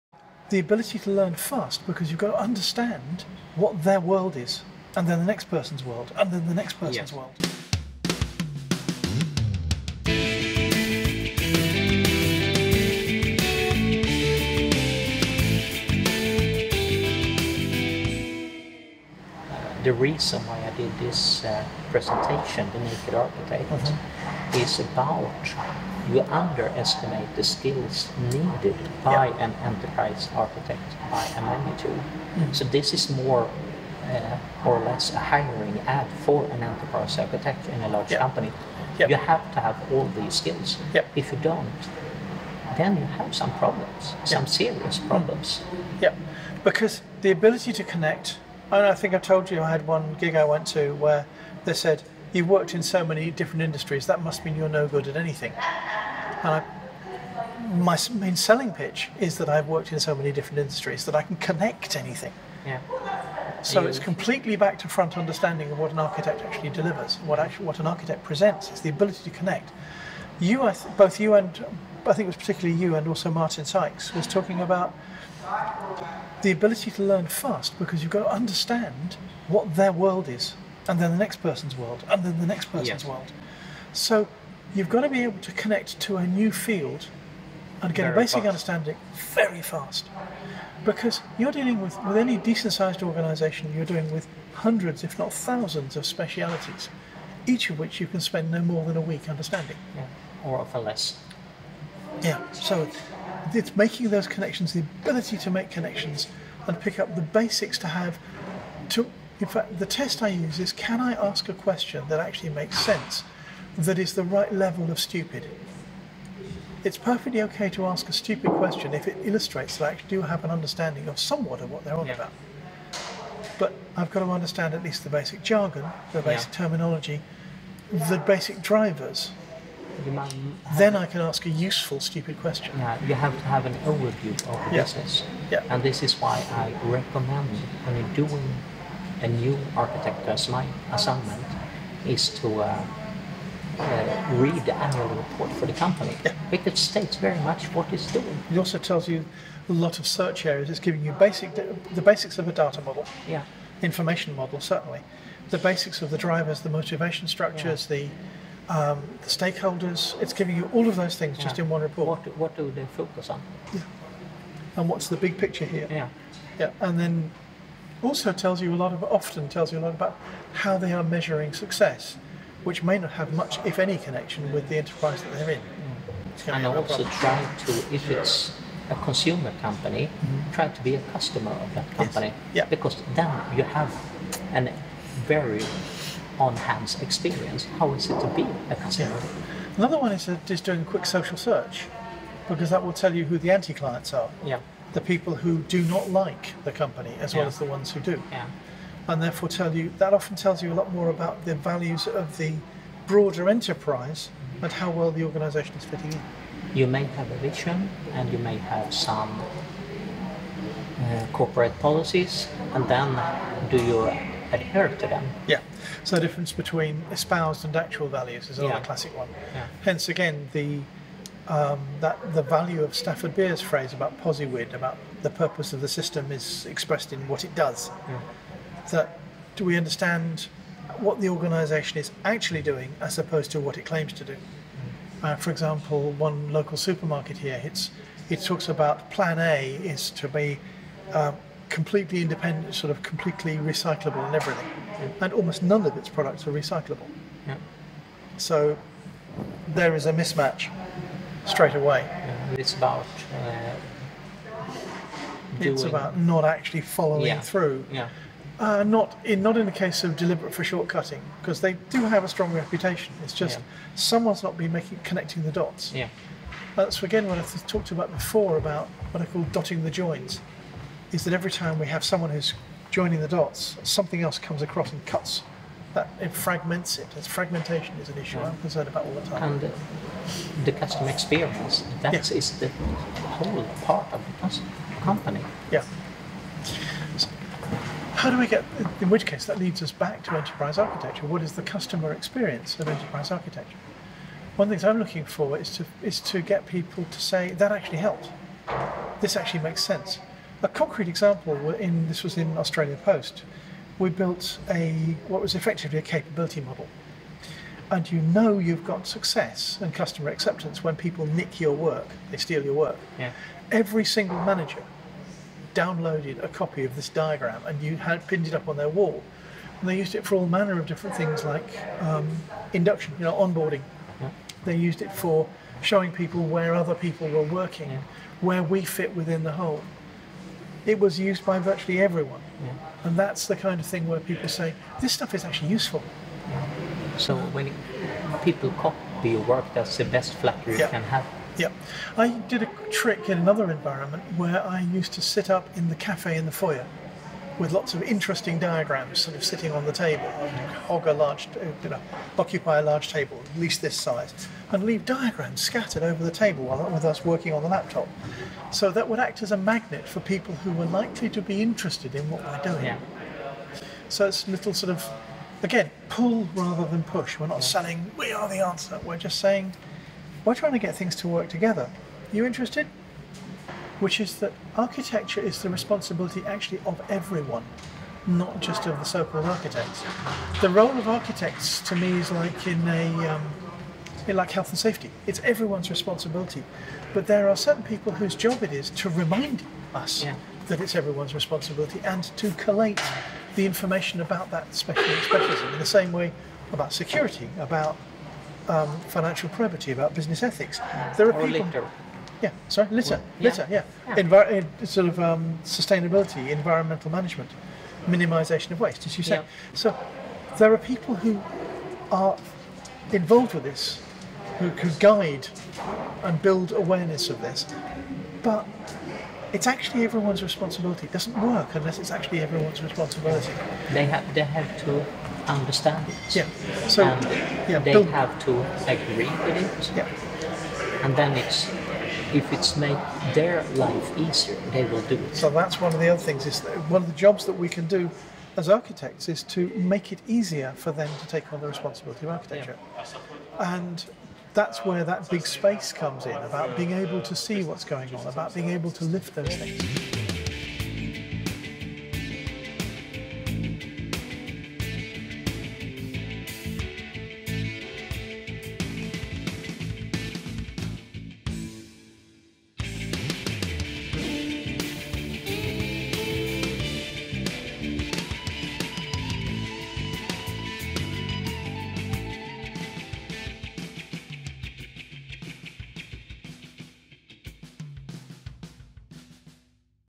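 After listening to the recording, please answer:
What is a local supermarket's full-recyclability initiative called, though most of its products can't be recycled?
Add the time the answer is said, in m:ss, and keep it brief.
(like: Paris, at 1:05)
Plan A, at 3:59.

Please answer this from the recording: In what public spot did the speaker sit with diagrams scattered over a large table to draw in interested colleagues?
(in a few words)
The cafe in the foyer.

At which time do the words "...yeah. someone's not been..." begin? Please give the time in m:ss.
4:23.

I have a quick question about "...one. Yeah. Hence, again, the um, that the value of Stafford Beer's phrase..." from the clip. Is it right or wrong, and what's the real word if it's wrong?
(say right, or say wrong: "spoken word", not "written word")
right.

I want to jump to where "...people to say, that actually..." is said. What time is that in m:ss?
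4:56.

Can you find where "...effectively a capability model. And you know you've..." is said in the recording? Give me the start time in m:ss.
5:05.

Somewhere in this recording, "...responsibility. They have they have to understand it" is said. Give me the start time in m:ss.
7:02.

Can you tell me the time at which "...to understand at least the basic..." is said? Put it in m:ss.
2:04.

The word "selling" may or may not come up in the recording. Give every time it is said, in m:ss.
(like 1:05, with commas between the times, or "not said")
0:58, 6:07.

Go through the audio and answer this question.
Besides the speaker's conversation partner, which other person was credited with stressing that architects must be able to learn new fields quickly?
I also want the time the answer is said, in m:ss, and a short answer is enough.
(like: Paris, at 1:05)
Martin Sykes, at 1:13.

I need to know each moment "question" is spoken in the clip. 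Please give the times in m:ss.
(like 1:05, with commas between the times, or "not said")
1:51, 1:58, 2:12.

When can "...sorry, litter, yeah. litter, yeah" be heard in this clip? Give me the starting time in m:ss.
6:42.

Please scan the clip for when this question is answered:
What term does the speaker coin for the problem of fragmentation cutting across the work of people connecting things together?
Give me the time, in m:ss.
4:29.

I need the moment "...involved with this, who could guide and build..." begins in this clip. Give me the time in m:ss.
6:53.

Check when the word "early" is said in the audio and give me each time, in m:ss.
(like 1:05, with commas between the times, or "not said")
not said.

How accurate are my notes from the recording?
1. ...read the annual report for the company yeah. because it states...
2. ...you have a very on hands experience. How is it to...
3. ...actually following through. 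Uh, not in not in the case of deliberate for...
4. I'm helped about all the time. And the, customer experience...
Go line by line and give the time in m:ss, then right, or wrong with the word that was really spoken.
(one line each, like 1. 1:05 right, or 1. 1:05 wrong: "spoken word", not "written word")
1. 2:24 right
2. 3:03 right
3. 4:16 right
4. 4:38 wrong: "concerned", not "helped".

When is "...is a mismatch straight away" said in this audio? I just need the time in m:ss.
4:09.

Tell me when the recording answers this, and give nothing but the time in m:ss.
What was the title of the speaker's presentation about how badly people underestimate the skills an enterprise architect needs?
0:22.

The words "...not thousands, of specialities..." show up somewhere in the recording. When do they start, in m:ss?
1:35.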